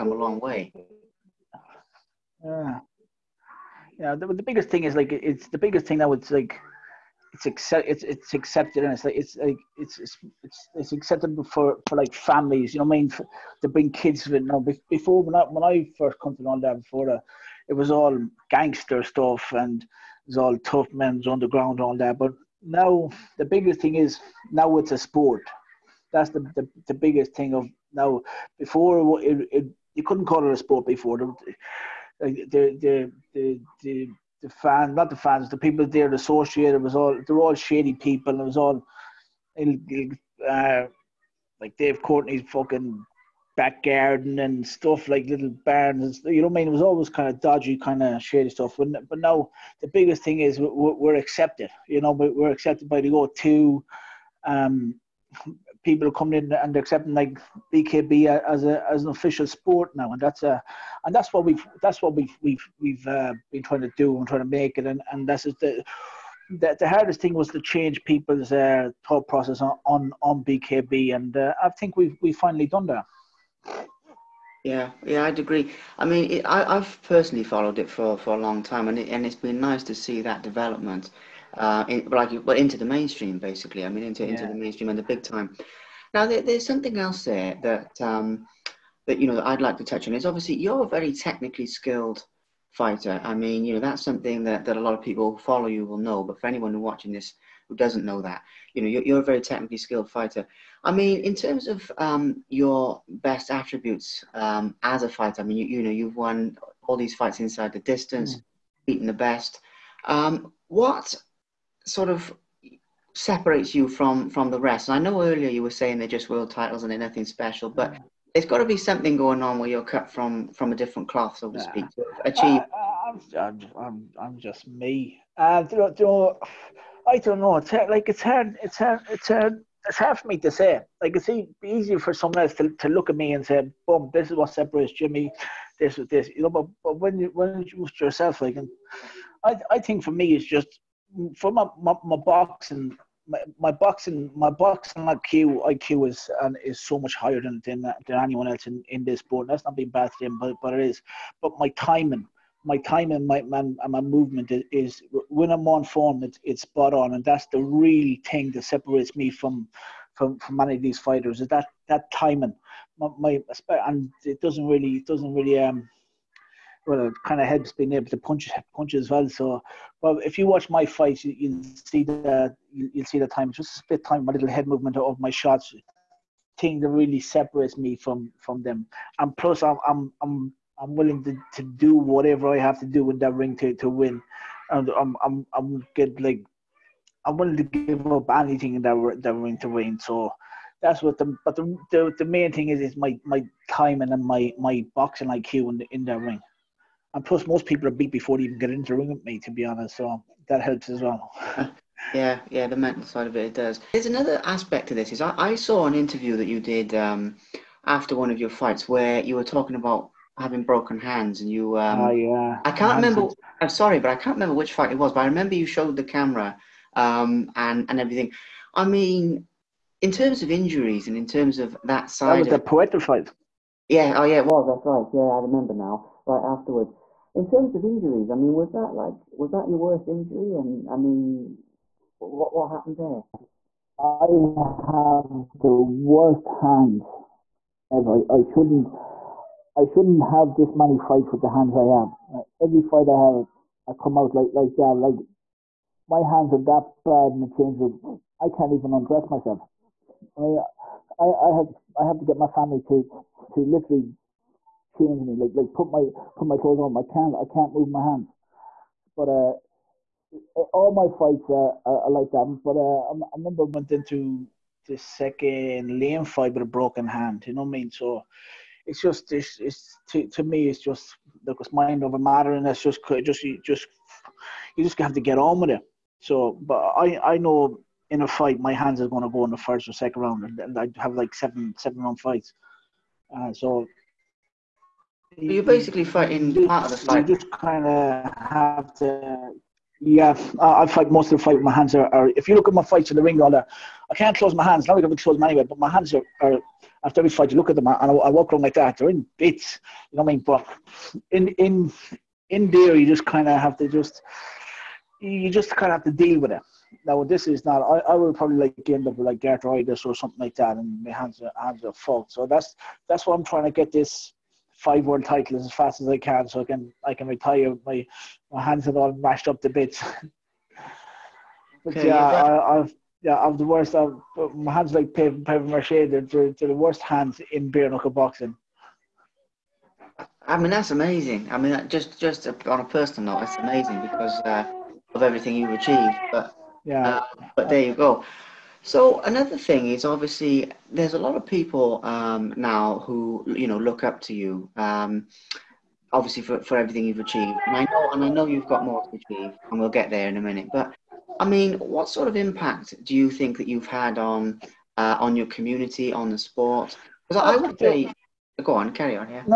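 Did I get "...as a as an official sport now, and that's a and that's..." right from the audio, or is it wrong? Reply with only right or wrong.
right.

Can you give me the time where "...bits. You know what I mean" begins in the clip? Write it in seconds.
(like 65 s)
299 s.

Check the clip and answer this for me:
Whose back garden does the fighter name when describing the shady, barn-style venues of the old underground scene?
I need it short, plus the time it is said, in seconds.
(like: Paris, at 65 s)
Dave Courtney, at 41 s.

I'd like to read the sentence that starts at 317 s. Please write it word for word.
My my hands are all mashed up to bits.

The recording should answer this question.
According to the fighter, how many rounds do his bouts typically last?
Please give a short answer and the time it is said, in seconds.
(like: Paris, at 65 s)
7, at 281 s.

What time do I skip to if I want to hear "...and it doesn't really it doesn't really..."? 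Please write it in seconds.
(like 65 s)
163 s.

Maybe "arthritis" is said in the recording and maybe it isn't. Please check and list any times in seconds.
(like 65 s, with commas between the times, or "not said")
309 s.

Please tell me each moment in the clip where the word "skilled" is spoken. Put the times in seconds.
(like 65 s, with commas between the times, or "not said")
91 s, 99 s.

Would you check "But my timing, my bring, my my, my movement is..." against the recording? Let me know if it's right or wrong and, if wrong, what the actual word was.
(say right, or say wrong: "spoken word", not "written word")
wrong: "timing", not "bring".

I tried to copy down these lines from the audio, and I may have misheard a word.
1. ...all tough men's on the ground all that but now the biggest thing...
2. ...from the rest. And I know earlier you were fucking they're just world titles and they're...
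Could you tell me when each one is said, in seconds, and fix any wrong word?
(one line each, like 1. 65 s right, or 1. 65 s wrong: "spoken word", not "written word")
1. 20 s right
2. 114 s wrong: "saying", not "fucking".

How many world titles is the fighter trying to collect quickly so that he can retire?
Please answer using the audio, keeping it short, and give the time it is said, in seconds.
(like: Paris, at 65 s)
5, at 314 s.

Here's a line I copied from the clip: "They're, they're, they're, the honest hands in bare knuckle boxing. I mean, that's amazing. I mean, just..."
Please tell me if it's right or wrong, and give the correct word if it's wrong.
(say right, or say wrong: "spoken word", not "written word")
wrong: "worst", not "honest".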